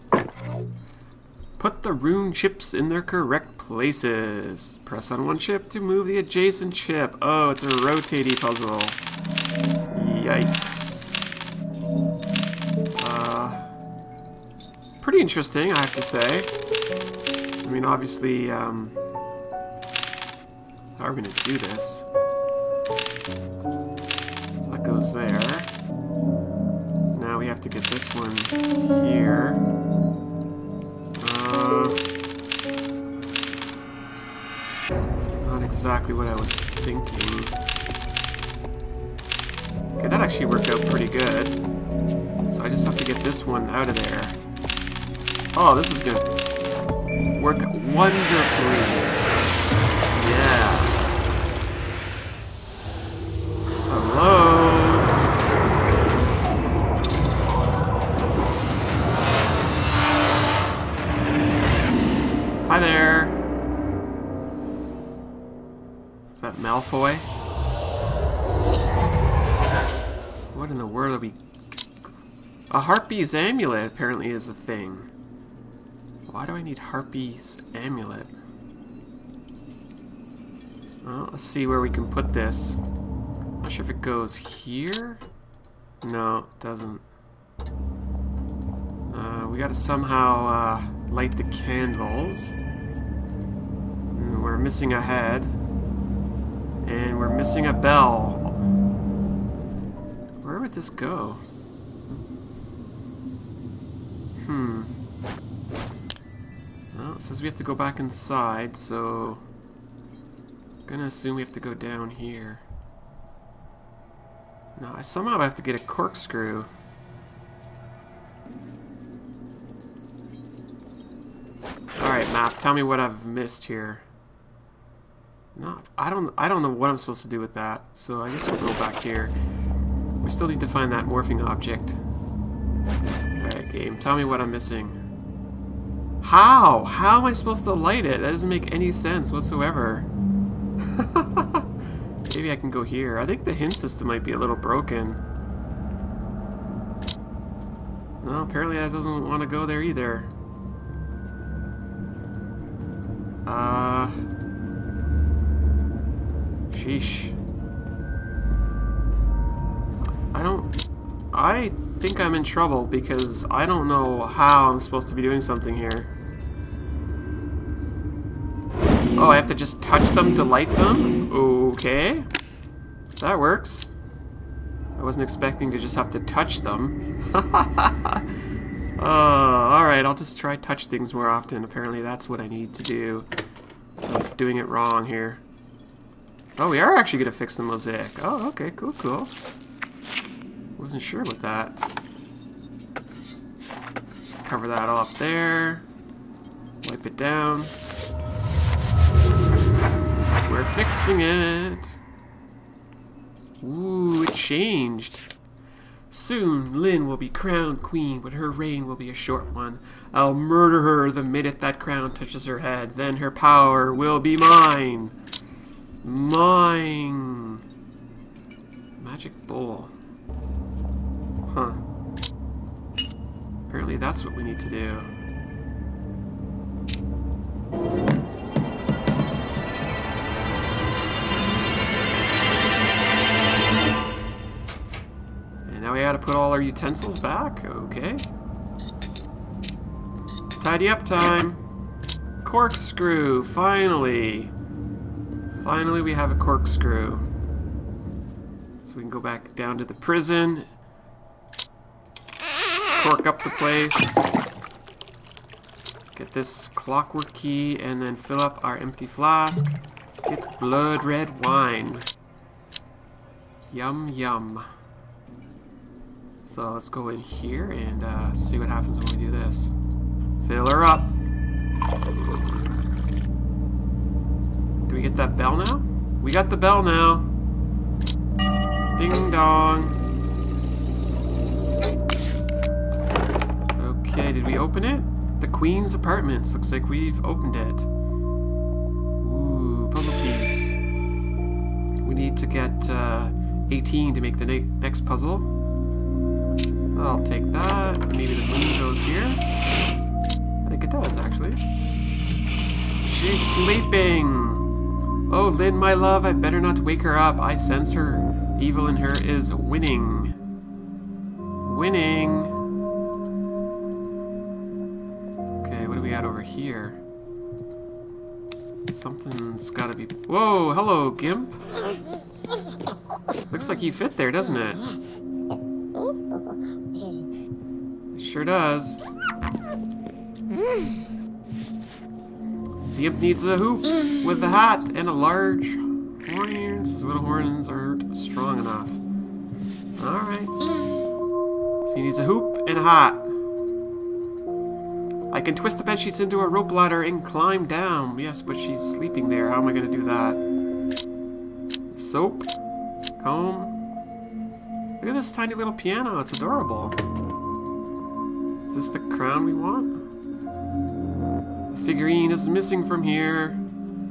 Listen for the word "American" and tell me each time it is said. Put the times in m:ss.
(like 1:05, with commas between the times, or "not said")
not said.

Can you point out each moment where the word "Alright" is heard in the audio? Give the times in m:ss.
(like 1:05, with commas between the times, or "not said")
2:01, 2:12, 2:59, 5:40.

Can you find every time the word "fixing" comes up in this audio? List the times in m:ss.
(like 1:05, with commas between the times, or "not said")
3:20.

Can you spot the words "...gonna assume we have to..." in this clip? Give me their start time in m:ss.
1:50.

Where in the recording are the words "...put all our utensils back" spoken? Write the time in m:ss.
3:56.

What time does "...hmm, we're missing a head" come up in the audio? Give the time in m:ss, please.
1:34.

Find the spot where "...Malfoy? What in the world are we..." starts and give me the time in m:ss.
1:06.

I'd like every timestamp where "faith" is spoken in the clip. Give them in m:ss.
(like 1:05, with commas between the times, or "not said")
not said.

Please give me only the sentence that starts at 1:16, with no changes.
Why do I need Harpy's Amulet?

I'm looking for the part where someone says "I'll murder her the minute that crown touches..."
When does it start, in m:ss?
3:30.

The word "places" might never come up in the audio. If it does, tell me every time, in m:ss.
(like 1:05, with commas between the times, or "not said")
0:03, 4:13.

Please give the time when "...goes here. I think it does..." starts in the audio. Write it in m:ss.
4:58.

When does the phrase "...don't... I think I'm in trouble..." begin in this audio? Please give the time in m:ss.
2:40.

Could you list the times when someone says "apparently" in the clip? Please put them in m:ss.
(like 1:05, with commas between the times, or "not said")
1:13, 2:28, 3:01, 3:43.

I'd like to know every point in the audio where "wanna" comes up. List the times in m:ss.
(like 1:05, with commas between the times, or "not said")
not said.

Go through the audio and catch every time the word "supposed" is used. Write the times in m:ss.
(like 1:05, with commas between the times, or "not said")
2:06, 2:17, 2:44.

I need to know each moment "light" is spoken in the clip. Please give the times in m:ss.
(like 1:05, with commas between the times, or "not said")
1:31, 2:17, 2:50.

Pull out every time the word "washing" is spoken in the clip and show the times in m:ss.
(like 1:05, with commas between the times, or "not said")
not said.